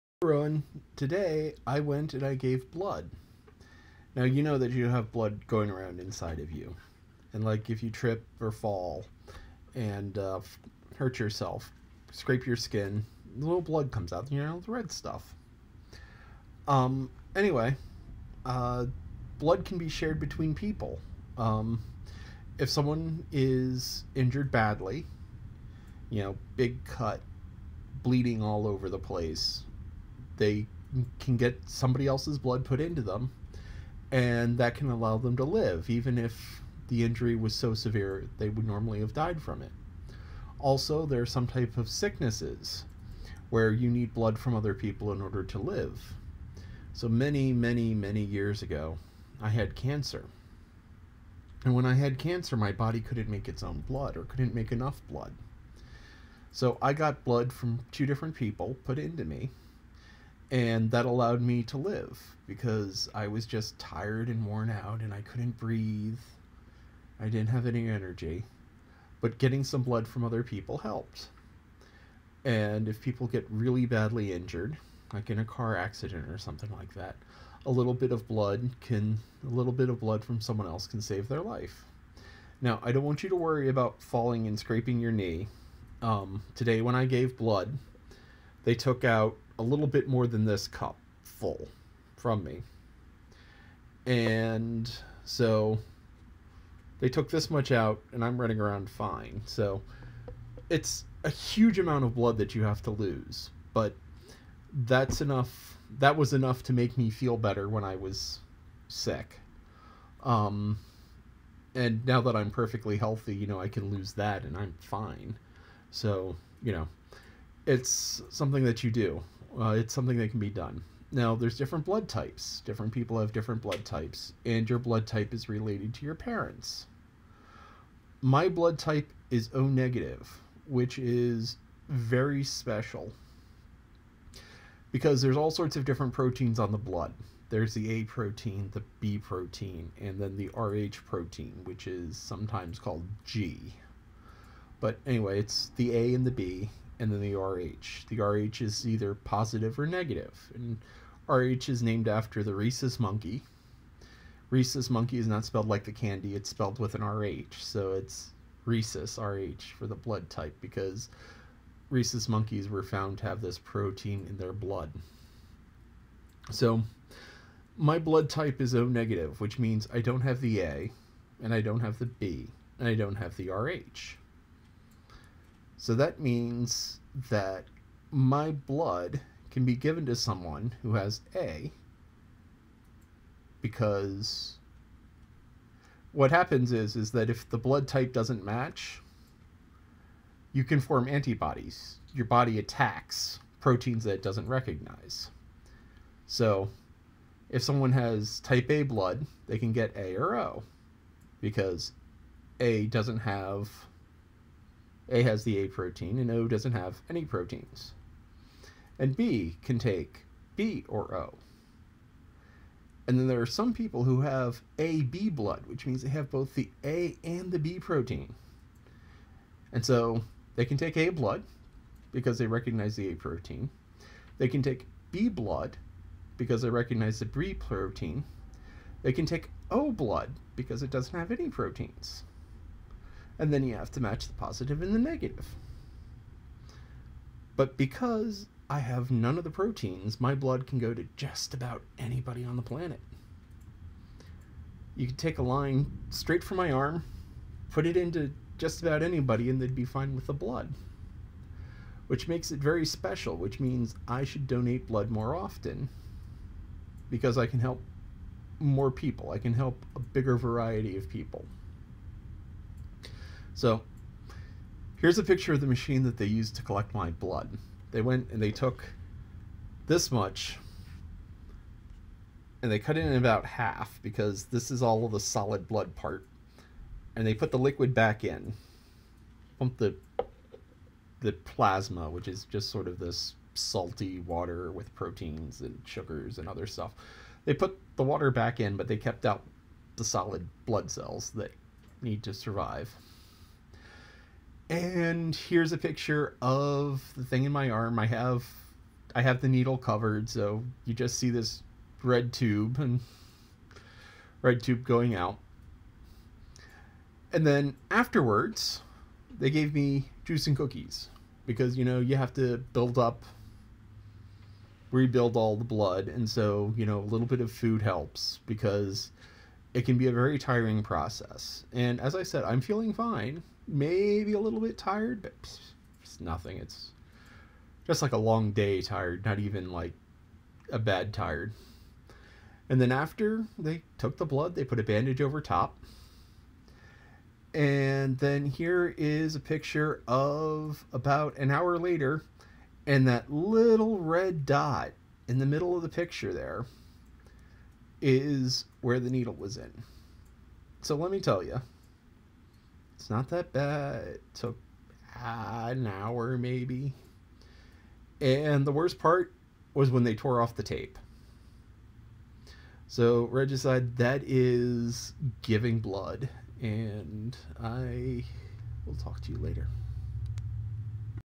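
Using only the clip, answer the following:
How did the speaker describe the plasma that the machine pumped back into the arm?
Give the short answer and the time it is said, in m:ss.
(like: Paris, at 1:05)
salty water, at 4:43.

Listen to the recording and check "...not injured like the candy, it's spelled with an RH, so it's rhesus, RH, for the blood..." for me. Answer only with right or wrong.
wrong.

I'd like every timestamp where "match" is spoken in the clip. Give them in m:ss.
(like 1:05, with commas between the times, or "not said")
3:08, 3:53.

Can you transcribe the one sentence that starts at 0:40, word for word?
Also, there are some type of sicknesses where you need blood from other people in order to live.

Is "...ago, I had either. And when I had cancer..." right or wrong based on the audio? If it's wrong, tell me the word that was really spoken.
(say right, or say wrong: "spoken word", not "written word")
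wrong: "cancer", not "either".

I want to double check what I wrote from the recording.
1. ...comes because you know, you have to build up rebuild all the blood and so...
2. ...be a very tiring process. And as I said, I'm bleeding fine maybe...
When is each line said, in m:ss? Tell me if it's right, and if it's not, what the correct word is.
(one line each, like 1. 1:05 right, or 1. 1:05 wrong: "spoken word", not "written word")
1. 5:10 wrong: "cookies", not "comes"
2. 5:19 wrong: "feeling", not "bleeding".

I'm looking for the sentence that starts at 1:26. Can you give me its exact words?
Um, today, when I gave blood, they took out a little bit more than this cup full from me.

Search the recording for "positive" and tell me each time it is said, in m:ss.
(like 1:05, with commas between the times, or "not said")
2:29, 3:54.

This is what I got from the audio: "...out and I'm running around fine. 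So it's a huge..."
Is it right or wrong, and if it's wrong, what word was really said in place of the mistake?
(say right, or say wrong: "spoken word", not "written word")
right.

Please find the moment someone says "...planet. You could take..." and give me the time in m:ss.
4:02.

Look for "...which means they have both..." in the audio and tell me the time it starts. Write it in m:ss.
3:35.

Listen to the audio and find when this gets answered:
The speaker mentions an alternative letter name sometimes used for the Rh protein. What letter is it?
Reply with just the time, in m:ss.
2:23.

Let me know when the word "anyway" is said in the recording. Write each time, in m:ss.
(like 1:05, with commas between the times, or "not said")
0:17, 2:25.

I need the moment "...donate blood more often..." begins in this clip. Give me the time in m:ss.
4:14.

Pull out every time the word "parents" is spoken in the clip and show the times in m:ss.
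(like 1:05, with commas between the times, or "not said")
2:06.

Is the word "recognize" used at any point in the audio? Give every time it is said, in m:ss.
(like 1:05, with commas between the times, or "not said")
3:14, 3:42, 3:46.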